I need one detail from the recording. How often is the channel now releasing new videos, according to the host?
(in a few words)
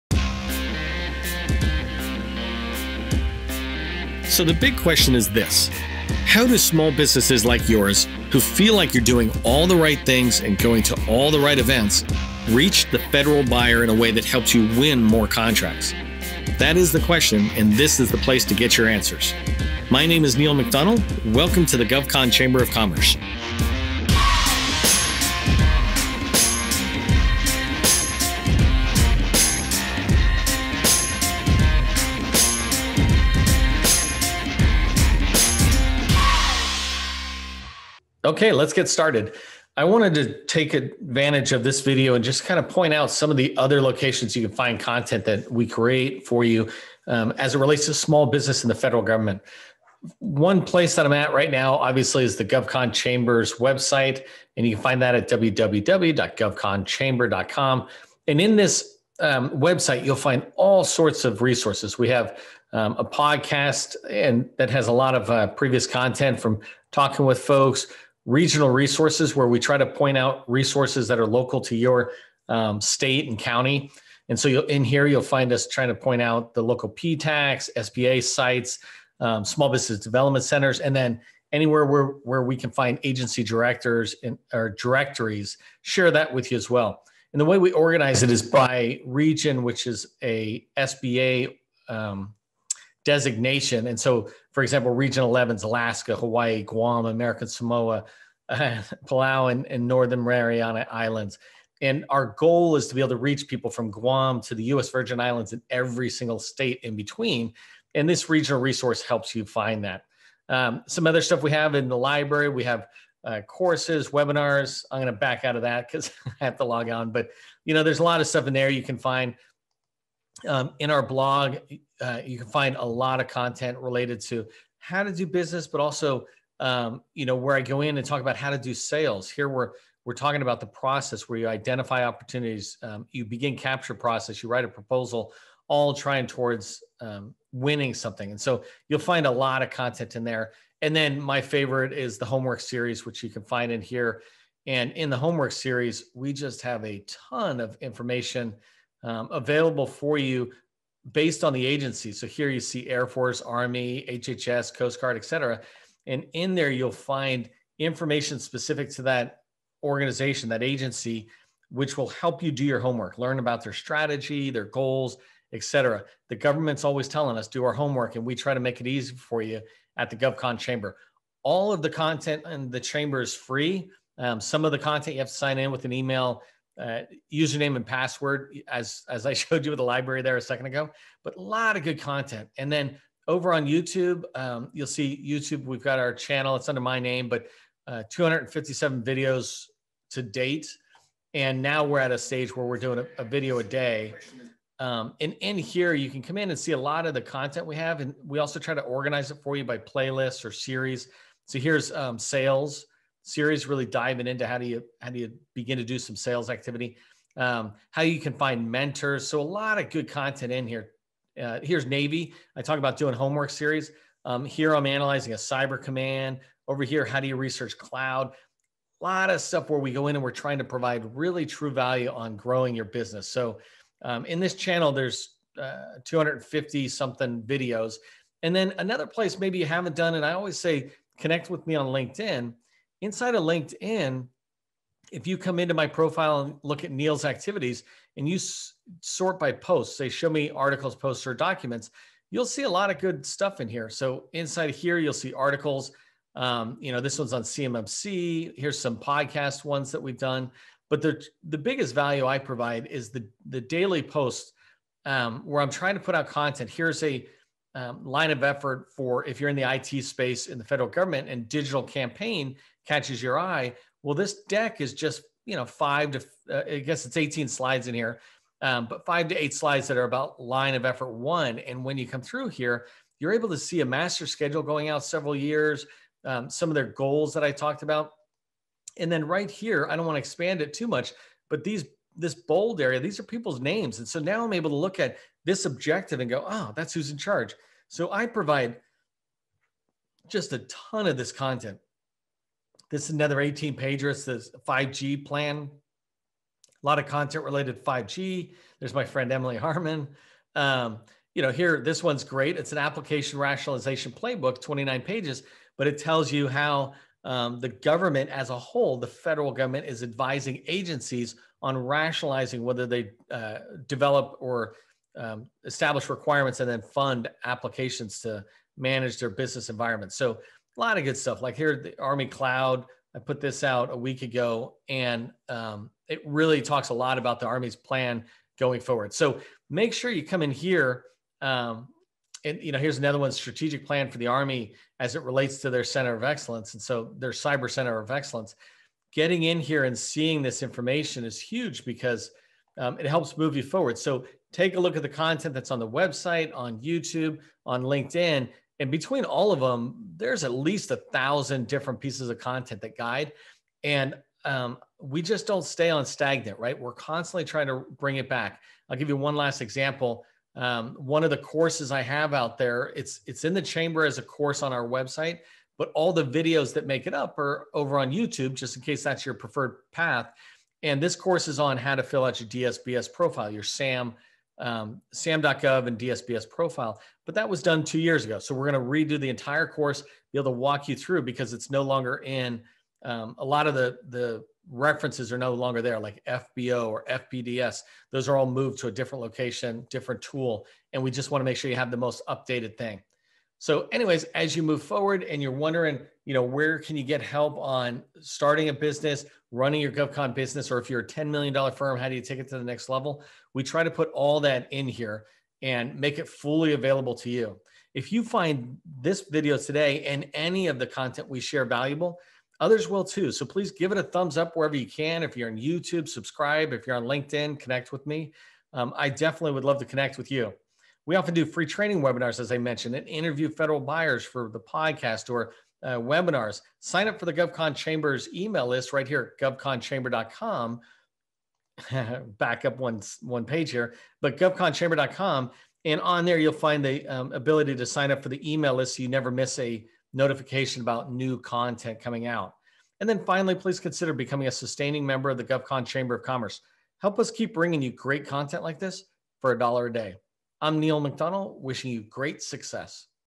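A video a day.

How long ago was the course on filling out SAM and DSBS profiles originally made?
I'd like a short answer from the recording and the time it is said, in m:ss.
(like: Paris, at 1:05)
Two years ago, at 6:17.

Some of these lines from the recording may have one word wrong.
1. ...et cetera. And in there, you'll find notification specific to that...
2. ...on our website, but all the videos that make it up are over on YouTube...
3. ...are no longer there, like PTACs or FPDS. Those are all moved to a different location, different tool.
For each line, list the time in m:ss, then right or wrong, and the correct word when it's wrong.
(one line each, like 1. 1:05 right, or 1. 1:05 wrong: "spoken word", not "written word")
1. 2:35 wrong: "information", not "notification"
2. 6:04 right
3. 6:25 wrong: "FBO", not "PTACs".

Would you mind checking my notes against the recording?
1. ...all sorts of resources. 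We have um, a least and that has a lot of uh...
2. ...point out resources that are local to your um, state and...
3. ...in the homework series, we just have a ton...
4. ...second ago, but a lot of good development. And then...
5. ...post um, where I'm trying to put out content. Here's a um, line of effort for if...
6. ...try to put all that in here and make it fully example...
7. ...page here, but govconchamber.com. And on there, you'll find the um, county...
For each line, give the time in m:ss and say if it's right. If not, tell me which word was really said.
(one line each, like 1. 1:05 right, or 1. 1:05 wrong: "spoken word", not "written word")
1. 1:00 wrong: "podcast", not "least"
2. 1:09 right
3. 2:24 right
4. 3:00 wrong: "content", not "development"
5. 4:14 right
6. 6:43 wrong: "available", not "example"
7. 7:13 wrong: "ability", not "county".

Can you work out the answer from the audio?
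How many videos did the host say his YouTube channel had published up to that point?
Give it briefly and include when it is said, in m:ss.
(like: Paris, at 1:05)
257, at 3:08.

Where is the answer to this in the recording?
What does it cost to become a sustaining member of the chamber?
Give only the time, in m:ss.
7:29.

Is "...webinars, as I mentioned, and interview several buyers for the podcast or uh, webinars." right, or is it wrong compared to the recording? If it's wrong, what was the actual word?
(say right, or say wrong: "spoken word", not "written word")
wrong: "federal", not "several".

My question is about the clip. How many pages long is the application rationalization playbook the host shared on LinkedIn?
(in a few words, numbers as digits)
29.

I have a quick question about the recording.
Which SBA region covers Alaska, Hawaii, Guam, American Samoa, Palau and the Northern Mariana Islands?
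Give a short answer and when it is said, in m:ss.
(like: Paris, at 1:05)
Region 11, at 1:34.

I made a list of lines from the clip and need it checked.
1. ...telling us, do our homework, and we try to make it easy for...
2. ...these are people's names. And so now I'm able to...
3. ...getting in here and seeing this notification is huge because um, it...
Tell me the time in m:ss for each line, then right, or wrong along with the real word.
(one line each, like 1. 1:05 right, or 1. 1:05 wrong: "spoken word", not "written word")
1. 2:47 right
2. 4:42 right
3. 5:39 wrong: "information", not "notification".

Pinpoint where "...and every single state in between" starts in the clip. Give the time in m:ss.
1:45.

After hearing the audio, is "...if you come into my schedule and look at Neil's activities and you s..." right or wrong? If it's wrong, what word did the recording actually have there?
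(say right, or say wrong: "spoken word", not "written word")
wrong: "profile", not "schedule".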